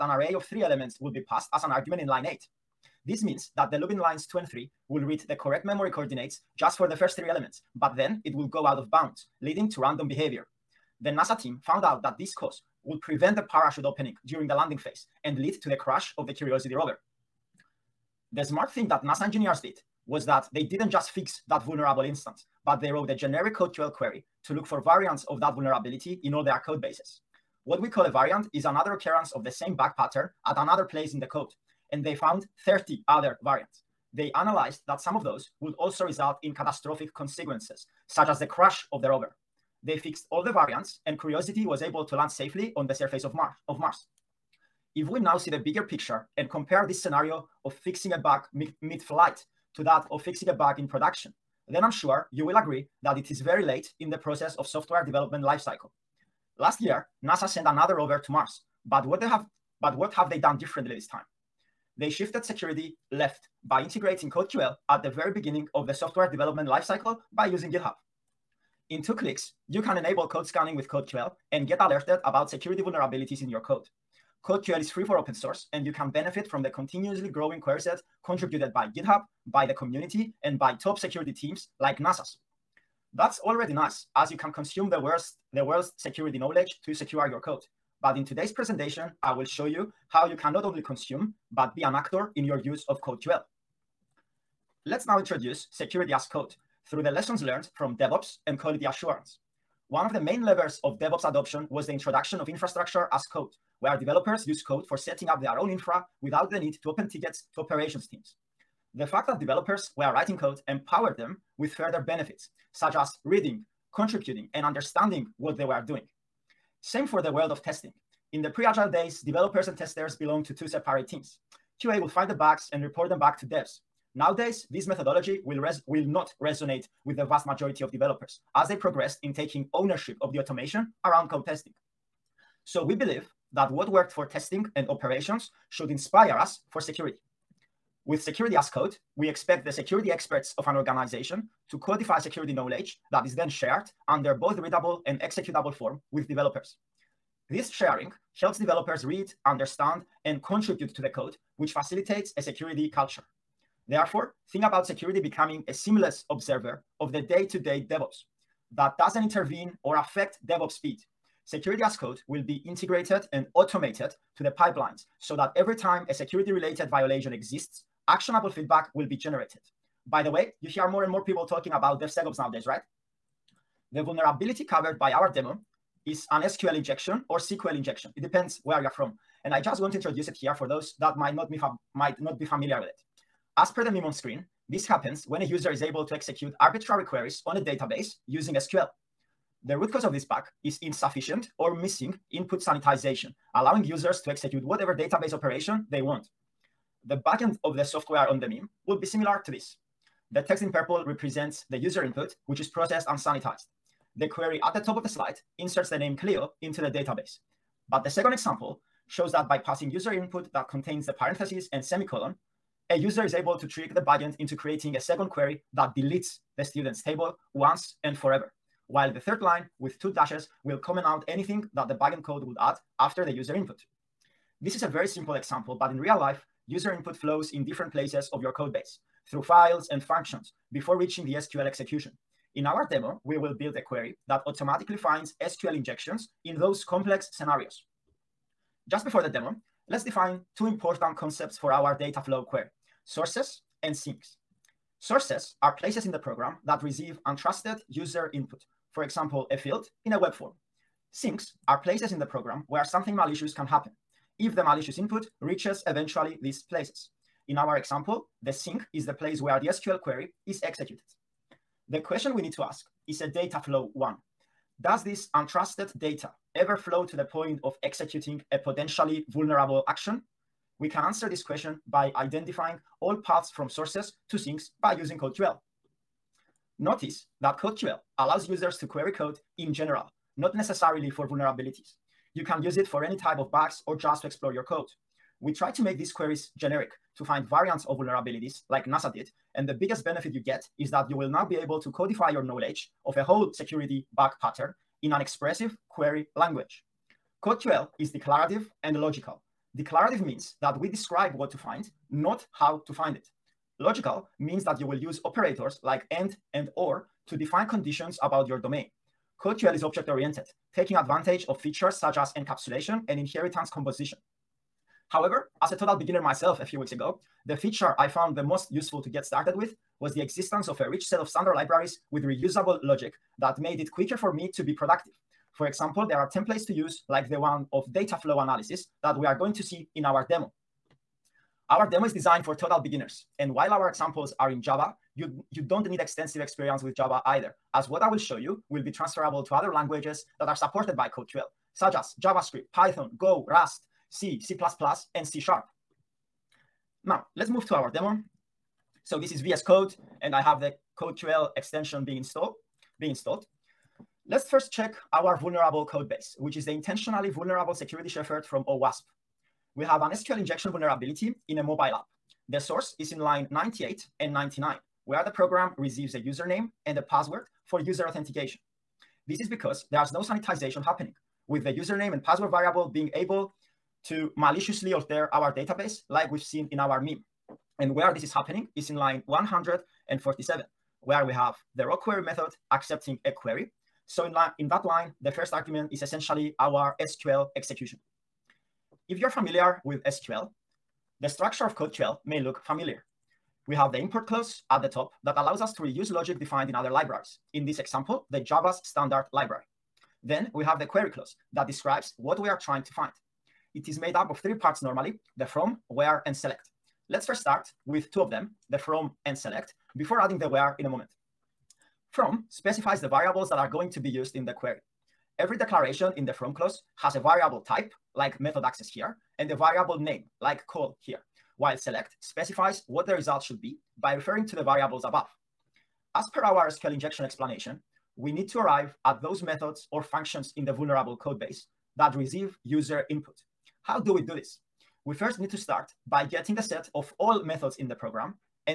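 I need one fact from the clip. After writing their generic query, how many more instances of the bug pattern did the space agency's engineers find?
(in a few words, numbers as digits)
30.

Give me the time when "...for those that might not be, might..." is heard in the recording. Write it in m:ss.
3:00.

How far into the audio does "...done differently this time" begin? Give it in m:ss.
1:00.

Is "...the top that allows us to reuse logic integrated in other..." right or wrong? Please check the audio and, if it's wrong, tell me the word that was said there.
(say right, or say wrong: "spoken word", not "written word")
wrong: "defined", not "integrated".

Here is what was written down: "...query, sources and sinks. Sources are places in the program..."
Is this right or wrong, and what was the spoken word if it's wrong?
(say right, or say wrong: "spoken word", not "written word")
right.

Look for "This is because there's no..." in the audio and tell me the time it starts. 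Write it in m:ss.
6:09.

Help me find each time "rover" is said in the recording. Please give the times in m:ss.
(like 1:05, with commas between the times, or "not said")
0:16, 0:39, 0:57.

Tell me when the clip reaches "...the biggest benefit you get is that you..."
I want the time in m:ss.
4:49.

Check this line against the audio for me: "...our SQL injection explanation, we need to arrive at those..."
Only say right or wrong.
right.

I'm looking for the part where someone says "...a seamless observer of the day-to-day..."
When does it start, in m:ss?
2:35.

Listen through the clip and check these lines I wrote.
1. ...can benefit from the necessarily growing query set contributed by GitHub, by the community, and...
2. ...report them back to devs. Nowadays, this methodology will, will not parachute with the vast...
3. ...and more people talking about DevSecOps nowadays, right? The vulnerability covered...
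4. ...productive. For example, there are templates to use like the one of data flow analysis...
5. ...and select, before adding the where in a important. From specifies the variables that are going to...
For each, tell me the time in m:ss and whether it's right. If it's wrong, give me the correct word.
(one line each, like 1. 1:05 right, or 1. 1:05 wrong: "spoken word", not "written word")
1. 1:15 wrong: "continuously", not "necessarily"
2. 2:02 wrong: "resonate", not "parachute"
3. 2:51 right
4. 5:24 right
5. 6:49 wrong: "moment", not "important".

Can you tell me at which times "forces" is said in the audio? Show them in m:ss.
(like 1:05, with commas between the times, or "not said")
not said.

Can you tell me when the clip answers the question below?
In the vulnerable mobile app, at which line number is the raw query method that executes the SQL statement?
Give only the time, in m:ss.
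6:19.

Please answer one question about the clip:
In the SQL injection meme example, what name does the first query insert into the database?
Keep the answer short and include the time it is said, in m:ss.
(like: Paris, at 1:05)
Clio, at 3:26.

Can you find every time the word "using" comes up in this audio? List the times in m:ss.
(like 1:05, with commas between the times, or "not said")
1:07, 3:08, 4:34.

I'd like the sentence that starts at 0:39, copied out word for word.
They fixed all the variants, and Curiosity was able to land safely on the surface of Mars.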